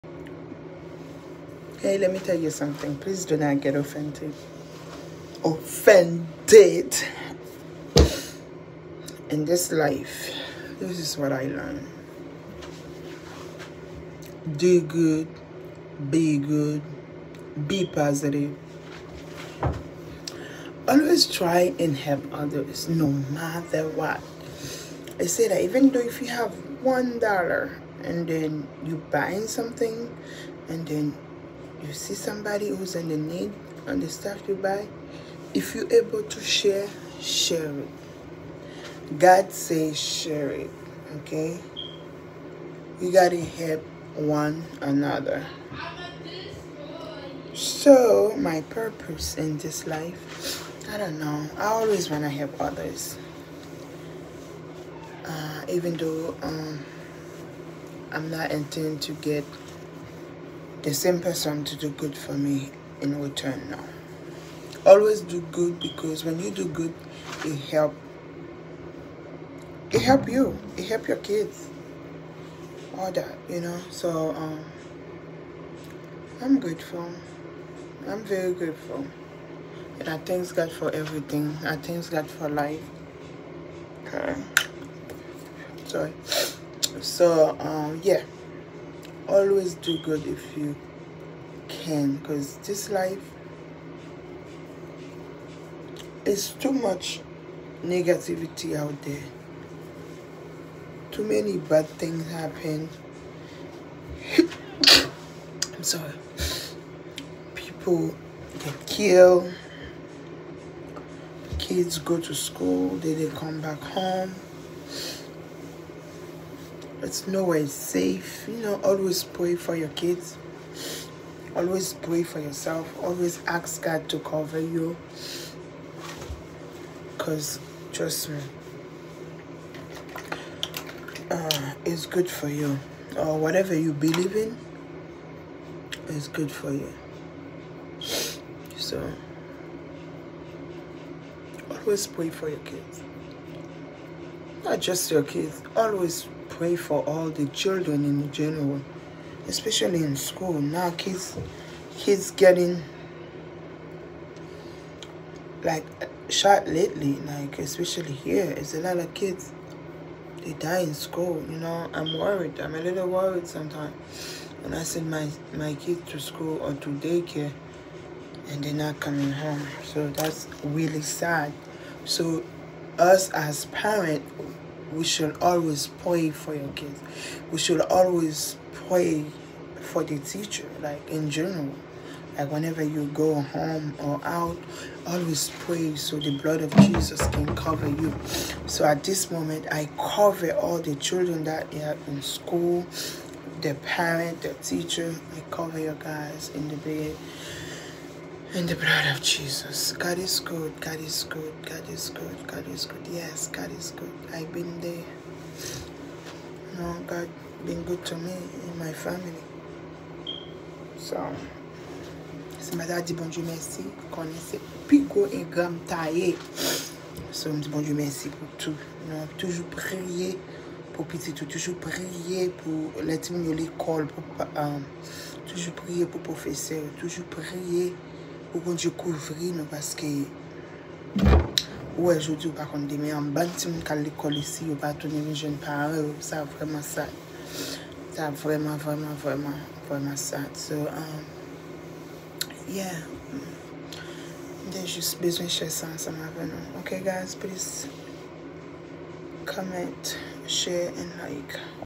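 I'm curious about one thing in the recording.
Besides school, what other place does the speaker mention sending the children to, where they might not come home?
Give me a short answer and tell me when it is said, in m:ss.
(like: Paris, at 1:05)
Daycare, at 2:46.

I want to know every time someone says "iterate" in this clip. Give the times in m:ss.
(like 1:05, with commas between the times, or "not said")
not said.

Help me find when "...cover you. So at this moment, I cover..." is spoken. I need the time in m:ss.
3:07.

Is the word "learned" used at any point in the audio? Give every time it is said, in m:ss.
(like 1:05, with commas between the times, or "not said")
0:11.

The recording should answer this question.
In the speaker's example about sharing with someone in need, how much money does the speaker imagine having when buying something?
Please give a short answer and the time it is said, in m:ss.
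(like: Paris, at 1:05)
$1, at 0:26.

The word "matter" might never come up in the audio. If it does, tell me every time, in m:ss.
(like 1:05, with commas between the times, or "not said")
0:23.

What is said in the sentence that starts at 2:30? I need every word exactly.
Now kids, kids getting like shot lately, like especially here.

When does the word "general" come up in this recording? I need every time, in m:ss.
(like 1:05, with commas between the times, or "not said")
2:28, 3:01.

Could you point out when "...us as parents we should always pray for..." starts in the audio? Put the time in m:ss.
2:52.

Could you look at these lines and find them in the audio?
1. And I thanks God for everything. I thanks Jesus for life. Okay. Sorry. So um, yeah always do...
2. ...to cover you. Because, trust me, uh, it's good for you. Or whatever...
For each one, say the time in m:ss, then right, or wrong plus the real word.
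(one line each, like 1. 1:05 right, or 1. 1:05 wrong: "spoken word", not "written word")
1. 1:19 wrong: "God", not "Jesus"
2. 2:04 right.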